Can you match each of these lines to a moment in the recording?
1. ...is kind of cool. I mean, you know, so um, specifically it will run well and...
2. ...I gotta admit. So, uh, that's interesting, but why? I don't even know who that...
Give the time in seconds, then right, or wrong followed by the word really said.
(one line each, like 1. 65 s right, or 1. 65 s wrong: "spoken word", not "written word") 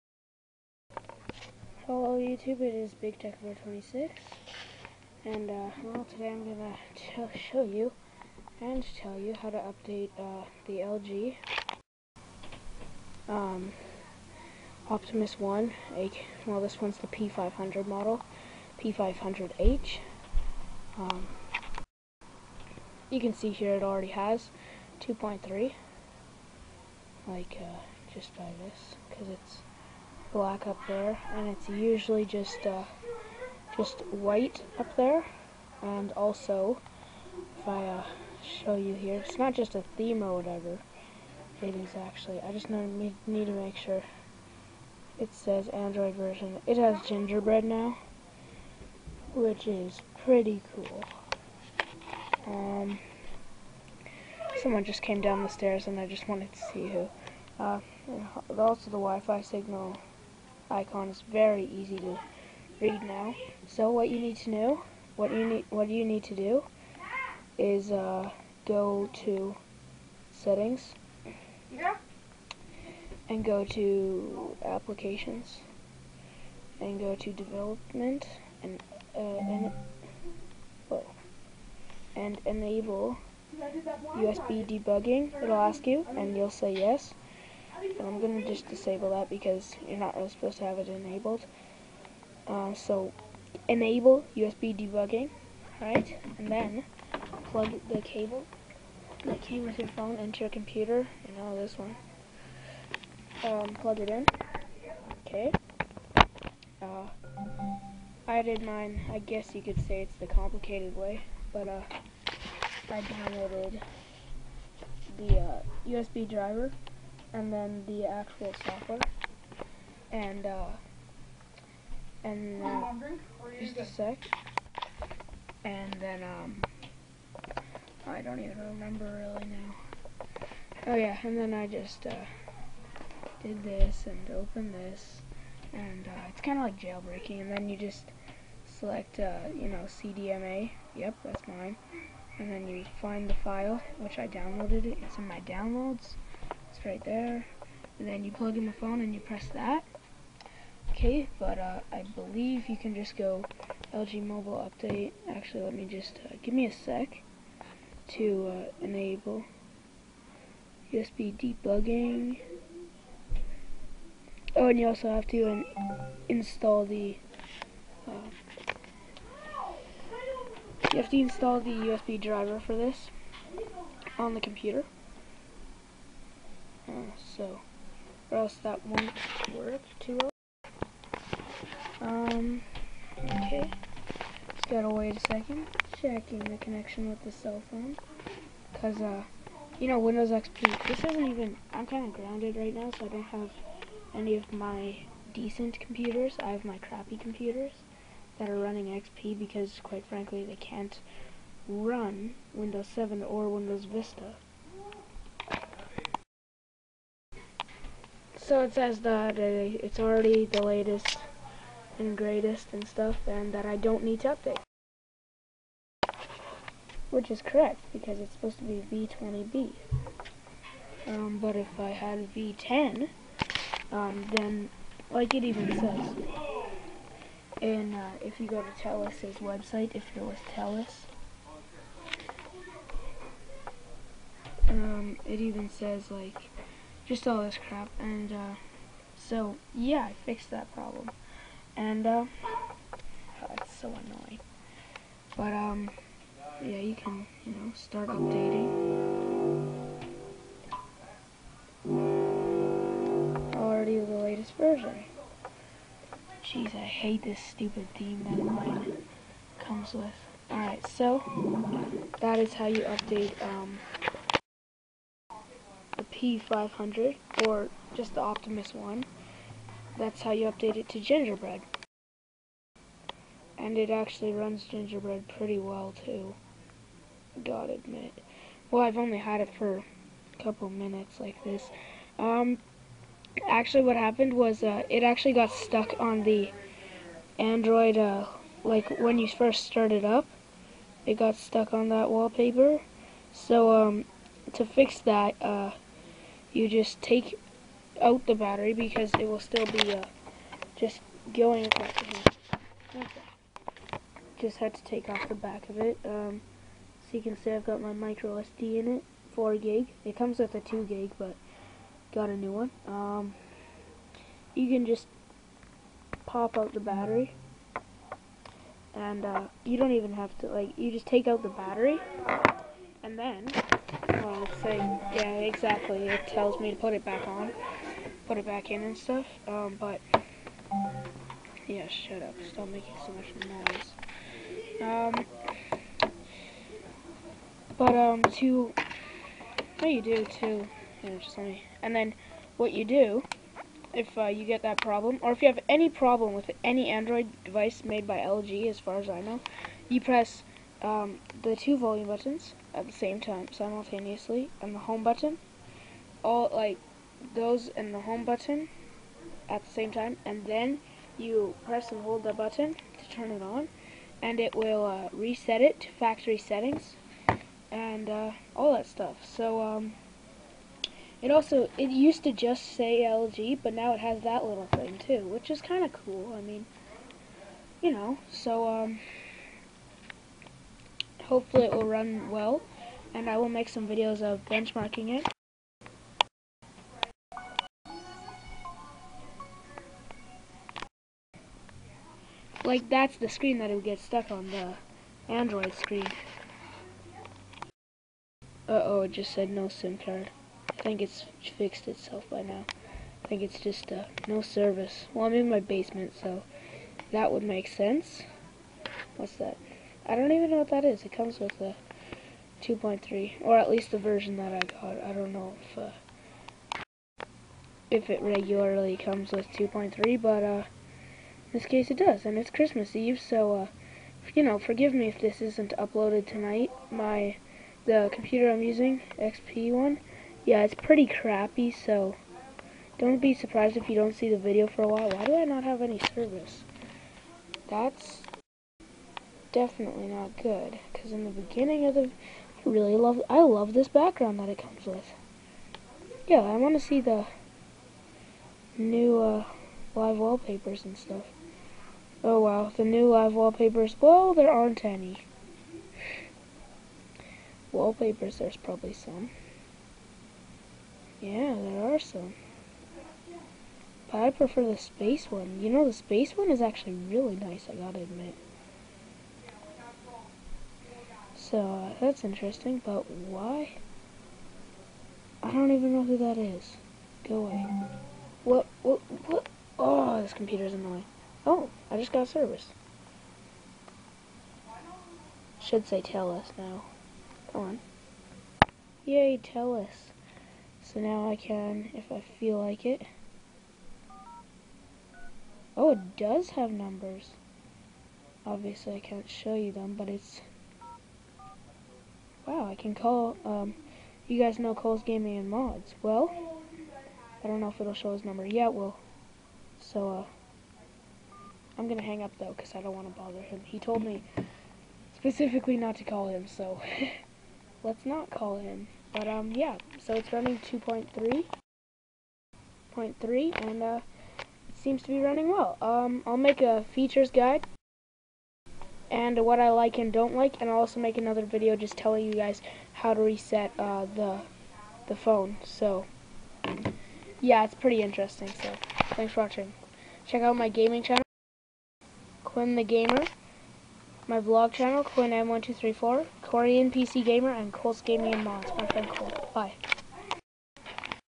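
1. 375 s wrong: "hopefully", not "specifically"
2. 467 s right.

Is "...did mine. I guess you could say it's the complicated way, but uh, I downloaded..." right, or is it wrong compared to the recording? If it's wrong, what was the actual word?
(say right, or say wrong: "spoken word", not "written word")
right.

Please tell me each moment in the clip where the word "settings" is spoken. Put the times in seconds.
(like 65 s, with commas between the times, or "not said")
70 s, 366 s.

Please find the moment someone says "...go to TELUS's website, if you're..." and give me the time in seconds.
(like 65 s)
228 s.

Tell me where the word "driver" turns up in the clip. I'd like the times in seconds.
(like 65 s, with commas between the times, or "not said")
116 s, 172 s.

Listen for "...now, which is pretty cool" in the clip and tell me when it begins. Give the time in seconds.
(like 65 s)
47 s.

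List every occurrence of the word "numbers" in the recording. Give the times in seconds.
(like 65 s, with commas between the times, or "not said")
496 s, 508 s.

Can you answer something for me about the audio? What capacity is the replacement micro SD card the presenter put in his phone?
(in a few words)
4 gig.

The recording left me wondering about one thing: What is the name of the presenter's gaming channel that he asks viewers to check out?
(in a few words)
Quinn the Gamer.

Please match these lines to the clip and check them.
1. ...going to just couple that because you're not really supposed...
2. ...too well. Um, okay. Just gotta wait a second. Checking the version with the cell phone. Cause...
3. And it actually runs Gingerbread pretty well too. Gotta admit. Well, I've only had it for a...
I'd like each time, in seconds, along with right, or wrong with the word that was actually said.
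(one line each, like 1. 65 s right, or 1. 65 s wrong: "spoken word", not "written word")
1. 88 s wrong: "disable", not "couple"
2. 179 s wrong: "connection", not "version"
3. 273 s right.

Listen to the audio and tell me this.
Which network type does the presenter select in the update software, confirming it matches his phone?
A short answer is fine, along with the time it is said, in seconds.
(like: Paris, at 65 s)
CDMA, at 139 s.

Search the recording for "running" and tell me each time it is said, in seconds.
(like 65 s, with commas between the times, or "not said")
198 s, 520 s, 525 s.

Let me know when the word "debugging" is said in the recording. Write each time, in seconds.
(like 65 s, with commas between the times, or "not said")
84 s, 94 s, 161 s.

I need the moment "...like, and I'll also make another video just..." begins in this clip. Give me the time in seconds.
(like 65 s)
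530 s.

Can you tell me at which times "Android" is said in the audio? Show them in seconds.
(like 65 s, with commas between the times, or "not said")
45 s, 287 s, 346 s, 395 s.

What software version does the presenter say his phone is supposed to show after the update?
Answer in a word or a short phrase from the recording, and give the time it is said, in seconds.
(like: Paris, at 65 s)
V20B, at 218 s.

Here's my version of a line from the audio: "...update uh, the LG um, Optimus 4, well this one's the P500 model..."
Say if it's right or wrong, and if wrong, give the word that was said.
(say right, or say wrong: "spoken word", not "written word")
wrong: "1", not "4".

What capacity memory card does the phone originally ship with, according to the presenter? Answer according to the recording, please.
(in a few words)
2 gig.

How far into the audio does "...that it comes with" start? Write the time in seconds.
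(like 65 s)
444 s.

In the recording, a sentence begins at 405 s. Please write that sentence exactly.
Well, I'm in my basement, so that would make sense.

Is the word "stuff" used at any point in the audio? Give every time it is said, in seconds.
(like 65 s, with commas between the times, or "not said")
212 s, 328 s, 368 s, 450 s.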